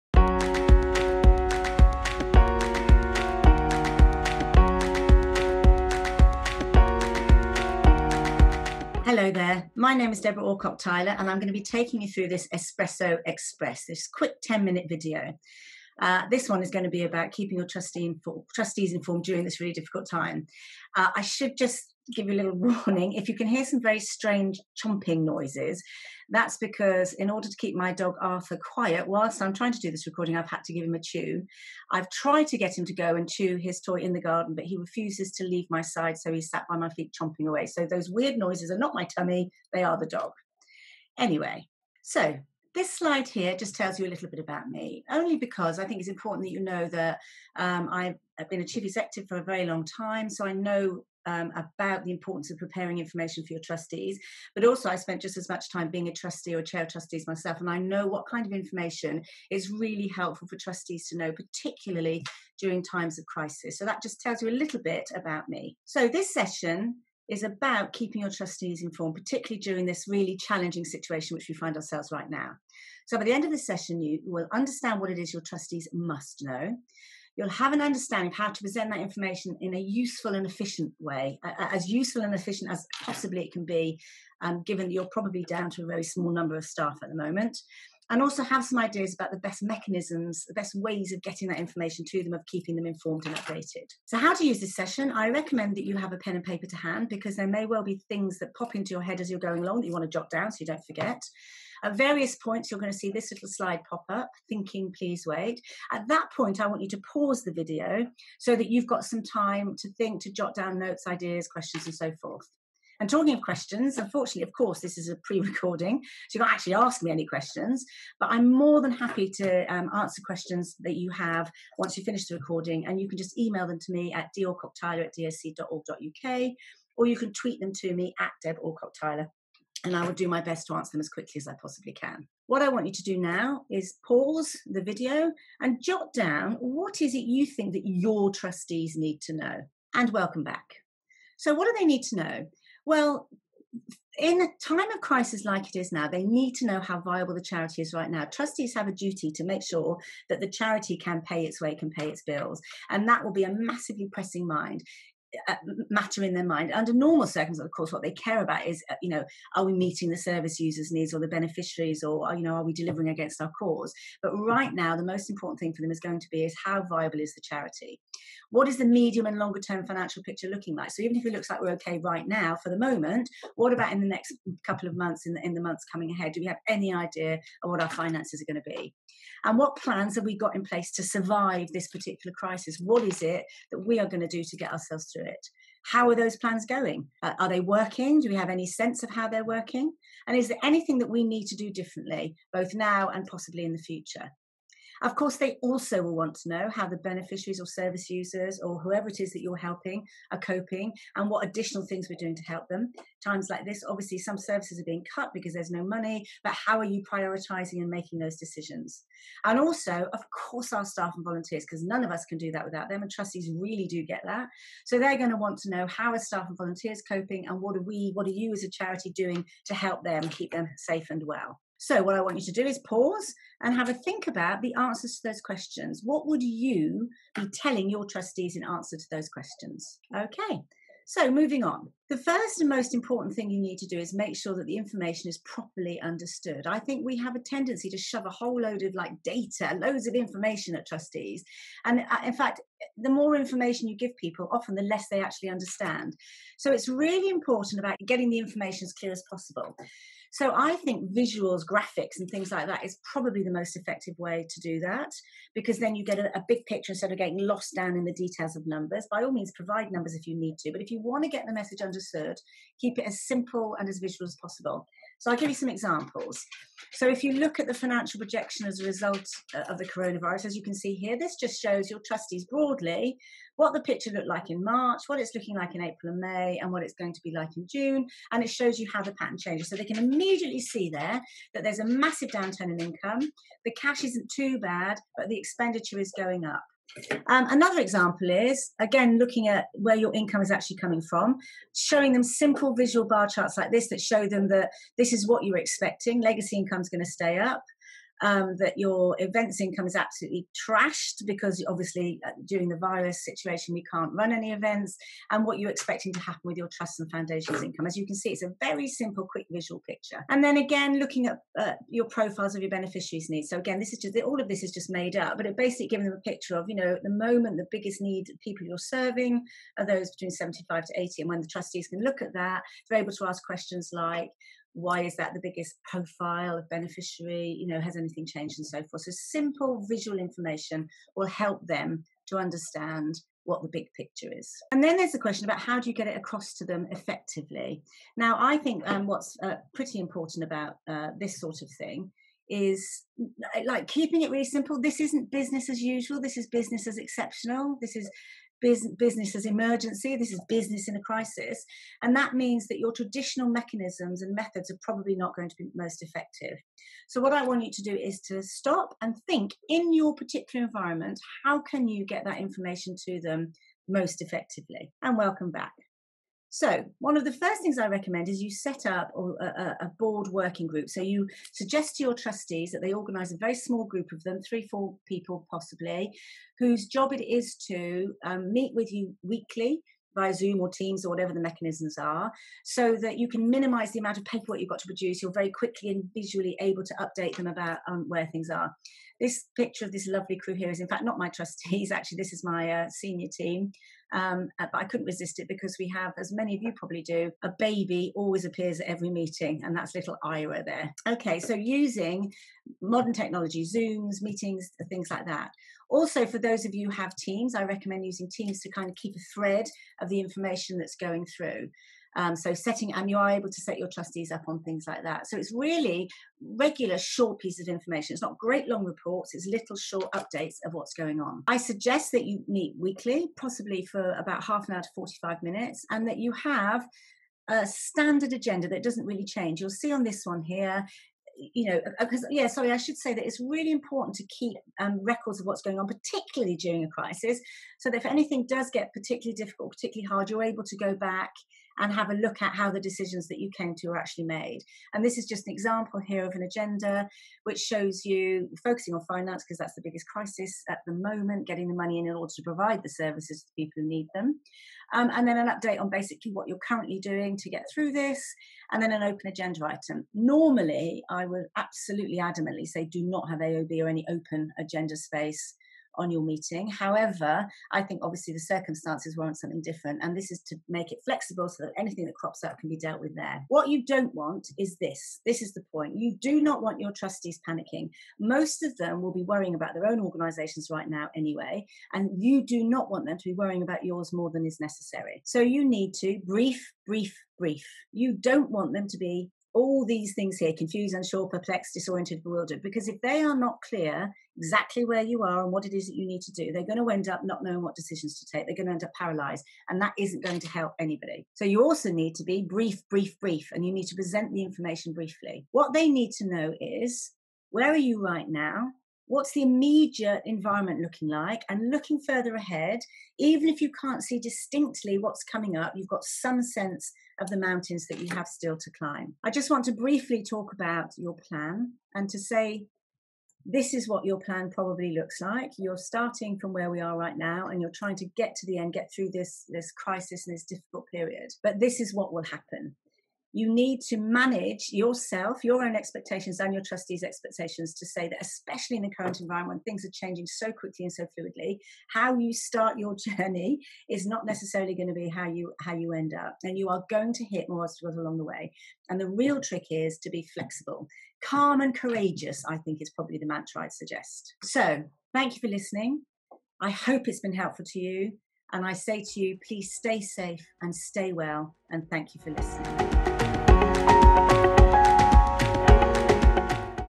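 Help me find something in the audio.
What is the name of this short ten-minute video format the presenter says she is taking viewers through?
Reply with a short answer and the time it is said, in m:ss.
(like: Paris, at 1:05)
Espresso Express, at 0:12.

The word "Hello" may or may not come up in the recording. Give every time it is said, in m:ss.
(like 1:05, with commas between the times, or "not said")
0:09.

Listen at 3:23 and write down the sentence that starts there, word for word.
Times like this, obviously, some services are being cut because there's no money, but how are you prioritizing and making those decisions?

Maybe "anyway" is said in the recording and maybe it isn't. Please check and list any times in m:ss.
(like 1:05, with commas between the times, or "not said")
0:41, 8:01.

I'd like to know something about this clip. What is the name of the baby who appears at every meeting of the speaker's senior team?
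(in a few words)
Ira.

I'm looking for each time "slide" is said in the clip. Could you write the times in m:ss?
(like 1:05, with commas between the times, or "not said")
0:42, 1:43.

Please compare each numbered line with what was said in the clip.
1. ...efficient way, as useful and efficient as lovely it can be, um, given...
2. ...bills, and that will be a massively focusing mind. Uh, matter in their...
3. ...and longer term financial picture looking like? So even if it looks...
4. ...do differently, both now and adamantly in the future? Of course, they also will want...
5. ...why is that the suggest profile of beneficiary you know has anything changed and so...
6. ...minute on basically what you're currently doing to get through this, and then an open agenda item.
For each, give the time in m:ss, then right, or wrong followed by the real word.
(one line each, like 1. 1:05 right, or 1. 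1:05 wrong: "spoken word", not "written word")
1. 1:20 wrong: "possibly", not "lovely"
2. 2:32 wrong: "pressing", not "focusing"
3. 2:49 right
4. 3:11 wrong: "possibly", not "adamantly"
5. 5:24 wrong: "biggest", not "suggest"
6. 7:35 wrong: "update", not "minute".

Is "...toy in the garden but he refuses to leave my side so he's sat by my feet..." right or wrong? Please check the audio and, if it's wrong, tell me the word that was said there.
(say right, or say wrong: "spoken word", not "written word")
right.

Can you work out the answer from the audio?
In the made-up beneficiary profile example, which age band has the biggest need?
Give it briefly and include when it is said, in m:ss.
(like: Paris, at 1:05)
75 to 80, at 5:20.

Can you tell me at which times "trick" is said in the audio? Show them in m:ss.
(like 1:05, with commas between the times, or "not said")
9:09.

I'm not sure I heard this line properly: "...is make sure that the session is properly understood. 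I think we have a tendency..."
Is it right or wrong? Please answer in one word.
wrong.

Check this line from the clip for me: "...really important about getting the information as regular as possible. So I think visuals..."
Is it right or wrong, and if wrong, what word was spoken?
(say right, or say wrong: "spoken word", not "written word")
wrong: "clear", not "regular".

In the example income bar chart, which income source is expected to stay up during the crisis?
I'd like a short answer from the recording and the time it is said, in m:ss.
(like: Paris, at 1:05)
Legacy income, at 4:56.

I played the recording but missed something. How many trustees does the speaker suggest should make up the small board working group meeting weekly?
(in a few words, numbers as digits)
3 or 4.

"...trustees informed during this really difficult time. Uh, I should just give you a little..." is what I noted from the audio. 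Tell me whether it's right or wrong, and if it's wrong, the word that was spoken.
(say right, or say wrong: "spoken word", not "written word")
right.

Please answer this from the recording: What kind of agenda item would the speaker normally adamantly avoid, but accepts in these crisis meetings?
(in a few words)
AOB.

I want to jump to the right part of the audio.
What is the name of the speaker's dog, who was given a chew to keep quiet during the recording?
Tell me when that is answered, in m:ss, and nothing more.
0:28.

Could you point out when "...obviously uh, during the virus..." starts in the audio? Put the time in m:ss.
5:01.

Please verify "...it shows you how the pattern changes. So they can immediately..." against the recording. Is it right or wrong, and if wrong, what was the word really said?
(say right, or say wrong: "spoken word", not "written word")
right.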